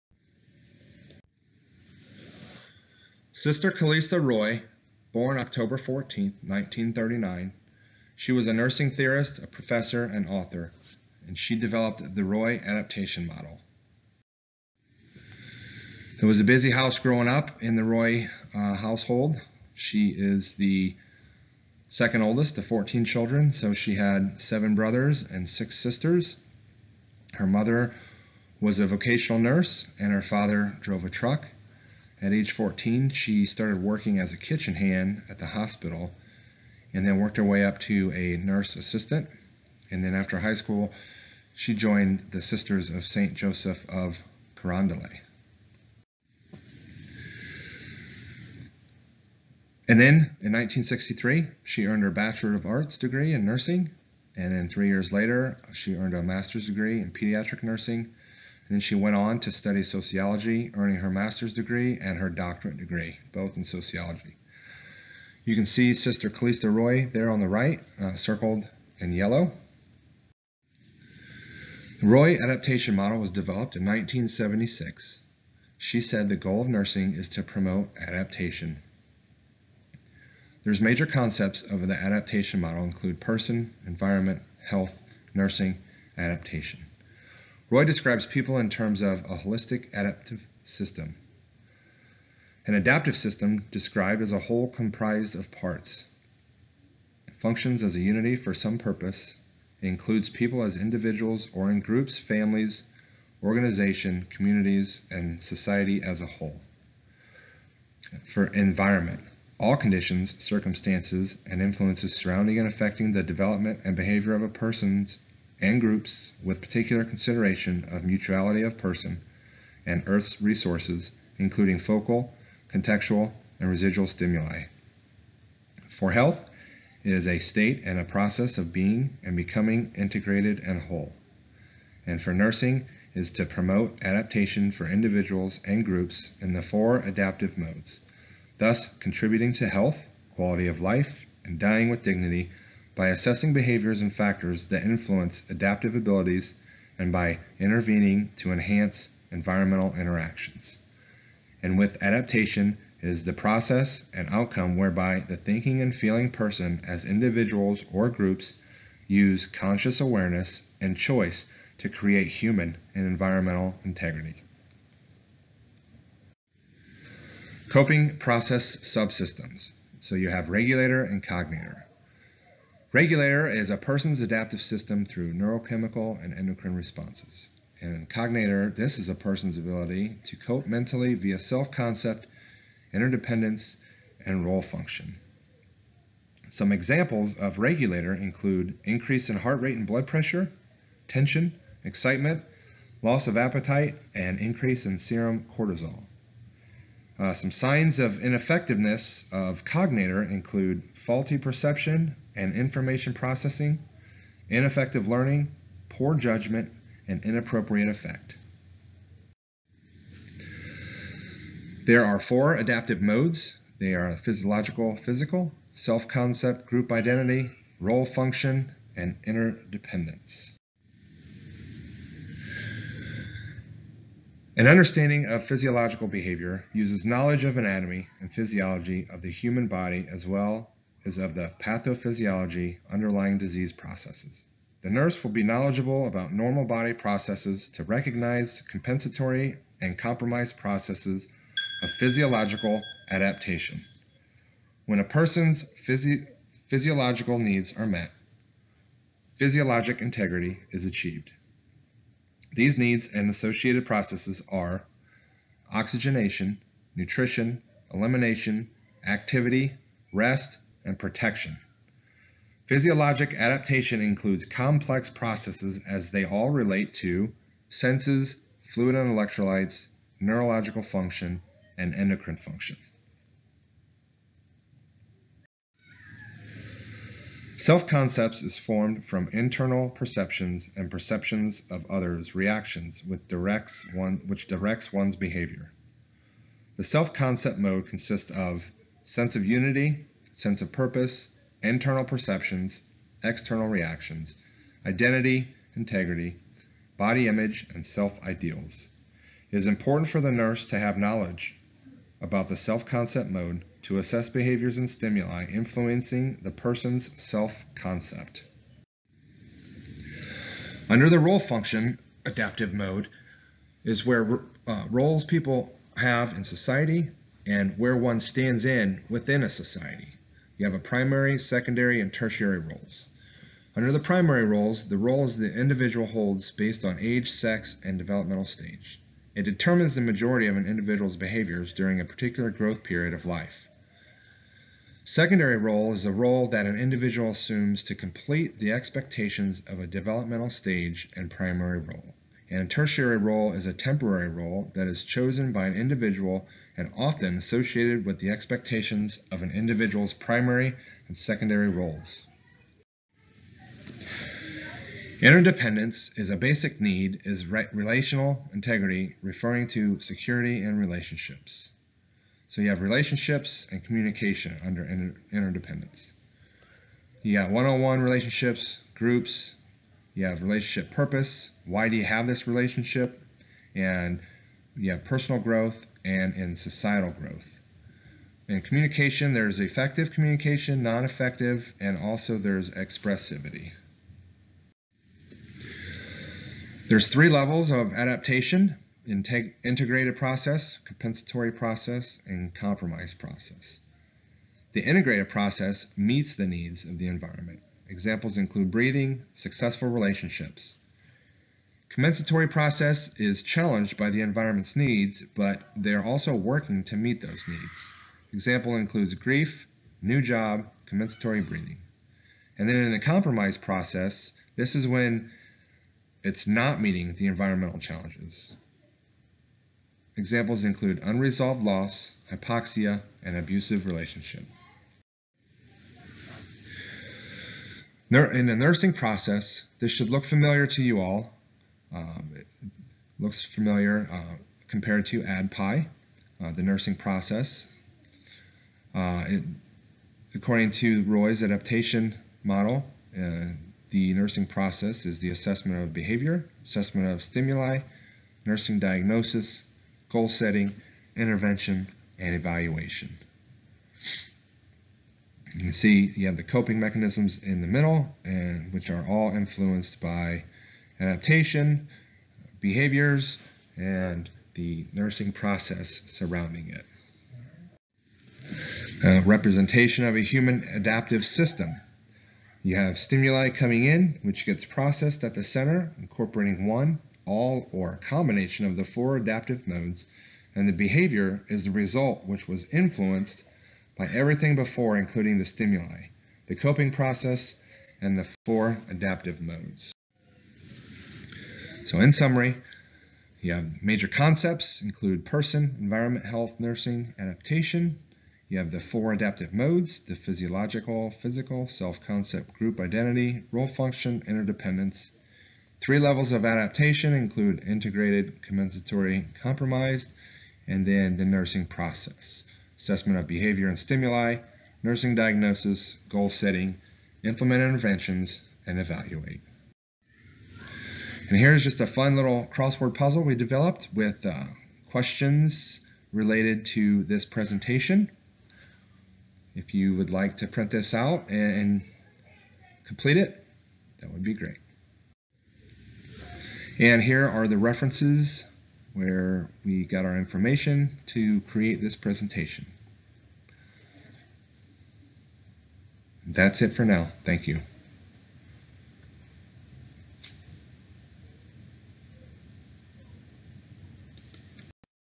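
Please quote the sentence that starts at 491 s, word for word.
So in summary, you have major concepts include person, environment, health, nursing, adaptation.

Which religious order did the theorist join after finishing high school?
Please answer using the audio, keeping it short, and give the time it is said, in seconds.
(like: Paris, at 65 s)
Sisters of St. Joseph of Carondelet, at 42 s.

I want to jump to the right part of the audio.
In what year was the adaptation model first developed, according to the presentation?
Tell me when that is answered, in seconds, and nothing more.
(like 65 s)
73 s.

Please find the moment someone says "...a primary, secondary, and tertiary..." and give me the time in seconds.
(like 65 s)
320 s.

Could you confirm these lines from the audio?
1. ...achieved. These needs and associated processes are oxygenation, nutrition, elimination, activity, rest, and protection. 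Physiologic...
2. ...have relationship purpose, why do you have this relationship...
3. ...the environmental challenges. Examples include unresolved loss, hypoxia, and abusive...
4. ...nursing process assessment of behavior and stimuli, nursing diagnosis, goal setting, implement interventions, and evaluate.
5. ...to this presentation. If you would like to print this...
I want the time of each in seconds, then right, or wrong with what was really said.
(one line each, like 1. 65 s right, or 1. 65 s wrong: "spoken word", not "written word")
1. 250 s right
2. 370 s right
3. 417 s right
4. 511 s right
5. 526 s right.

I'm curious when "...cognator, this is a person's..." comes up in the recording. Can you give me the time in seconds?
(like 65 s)
178 s.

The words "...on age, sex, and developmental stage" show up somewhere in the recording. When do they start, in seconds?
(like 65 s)
326 s.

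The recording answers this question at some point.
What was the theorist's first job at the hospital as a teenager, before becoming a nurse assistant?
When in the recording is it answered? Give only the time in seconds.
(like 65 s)
34 s.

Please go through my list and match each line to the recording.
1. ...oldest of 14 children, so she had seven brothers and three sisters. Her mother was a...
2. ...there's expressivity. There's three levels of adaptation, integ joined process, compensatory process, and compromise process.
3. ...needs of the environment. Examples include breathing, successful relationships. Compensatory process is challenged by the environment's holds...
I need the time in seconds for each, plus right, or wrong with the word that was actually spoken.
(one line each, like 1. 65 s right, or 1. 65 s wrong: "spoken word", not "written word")
1. 22 s wrong: "six", not "three"
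2. 382 s wrong: "integrated", not "joined"
3. 396 s wrong: "needs", not "holds".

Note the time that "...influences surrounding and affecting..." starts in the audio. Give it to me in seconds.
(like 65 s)
111 s.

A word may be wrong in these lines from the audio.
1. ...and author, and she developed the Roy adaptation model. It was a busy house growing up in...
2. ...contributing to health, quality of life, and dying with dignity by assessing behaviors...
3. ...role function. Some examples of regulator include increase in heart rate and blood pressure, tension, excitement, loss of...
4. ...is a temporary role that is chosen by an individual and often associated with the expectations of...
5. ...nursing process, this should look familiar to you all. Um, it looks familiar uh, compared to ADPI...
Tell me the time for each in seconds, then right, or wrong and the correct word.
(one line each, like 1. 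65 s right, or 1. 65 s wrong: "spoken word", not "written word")
1. 10 s right
2. 138 s right
3. 184 s right
4. 343 s right
5. 428 s right.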